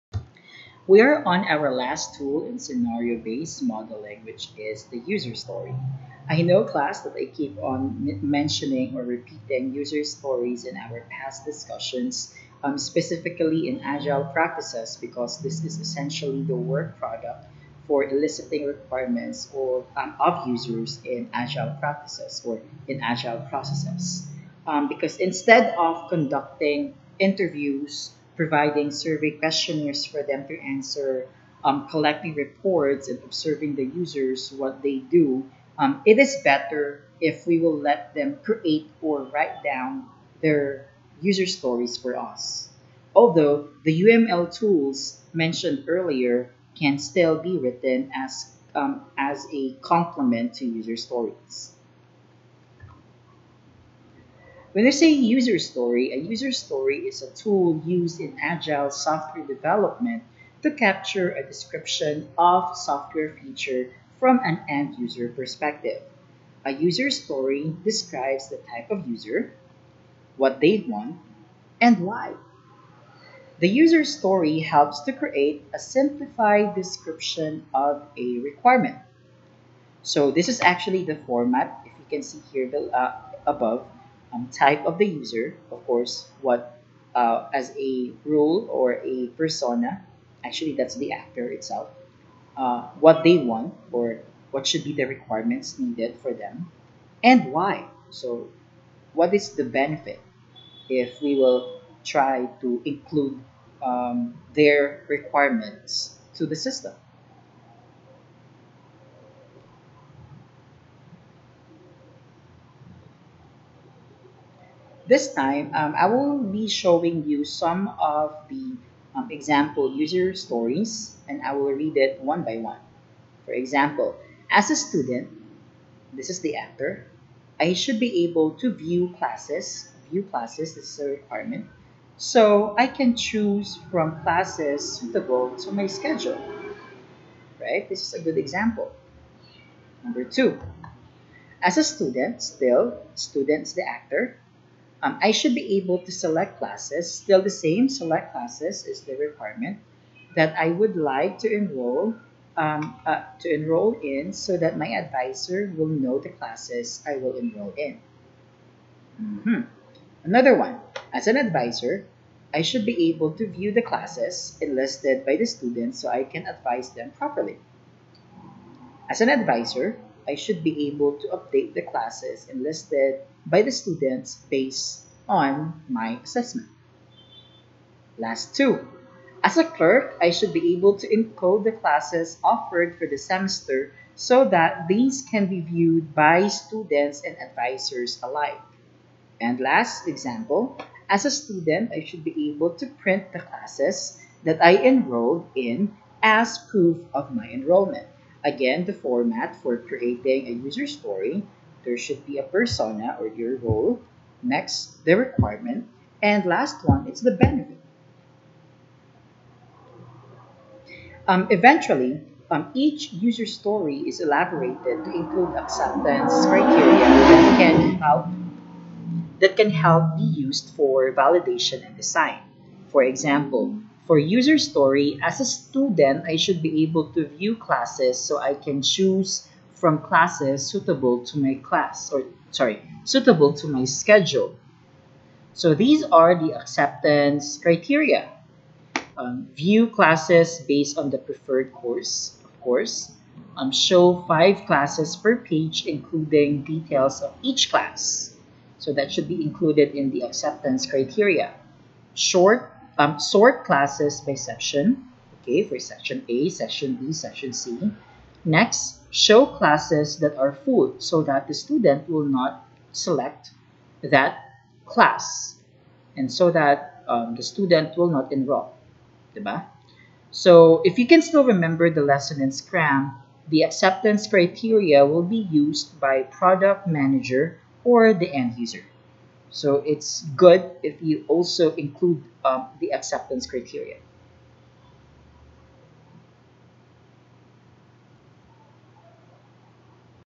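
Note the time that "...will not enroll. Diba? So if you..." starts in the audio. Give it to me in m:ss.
4:27.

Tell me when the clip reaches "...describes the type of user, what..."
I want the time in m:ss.
1:07.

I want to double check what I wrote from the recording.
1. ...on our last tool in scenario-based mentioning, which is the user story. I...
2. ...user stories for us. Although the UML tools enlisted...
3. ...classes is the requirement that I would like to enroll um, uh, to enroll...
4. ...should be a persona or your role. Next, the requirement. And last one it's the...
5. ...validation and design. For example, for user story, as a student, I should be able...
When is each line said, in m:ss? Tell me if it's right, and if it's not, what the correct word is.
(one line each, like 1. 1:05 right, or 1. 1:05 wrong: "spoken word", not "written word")
1. 0:01 wrong: "modeling", not "mentioning"
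2. 0:41 wrong: "mentioned", not "enlisted"
3. 2:28 right
4. 3:21 right
5. 3:41 right.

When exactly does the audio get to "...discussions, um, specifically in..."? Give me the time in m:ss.
0:11.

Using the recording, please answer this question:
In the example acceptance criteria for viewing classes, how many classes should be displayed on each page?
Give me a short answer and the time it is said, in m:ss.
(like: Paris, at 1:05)
5, at 4:04.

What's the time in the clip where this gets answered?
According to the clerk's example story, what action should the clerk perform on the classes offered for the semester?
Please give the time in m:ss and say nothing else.
3:01.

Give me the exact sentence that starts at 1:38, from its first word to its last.
So what is the benefit if we will try to include um, their requirements to the system?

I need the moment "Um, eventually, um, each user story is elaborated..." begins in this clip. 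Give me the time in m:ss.
3:31.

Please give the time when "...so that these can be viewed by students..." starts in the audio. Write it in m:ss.
3:04.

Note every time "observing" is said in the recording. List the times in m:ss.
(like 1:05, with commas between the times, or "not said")
0:33.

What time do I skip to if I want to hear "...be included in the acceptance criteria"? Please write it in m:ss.
4:09.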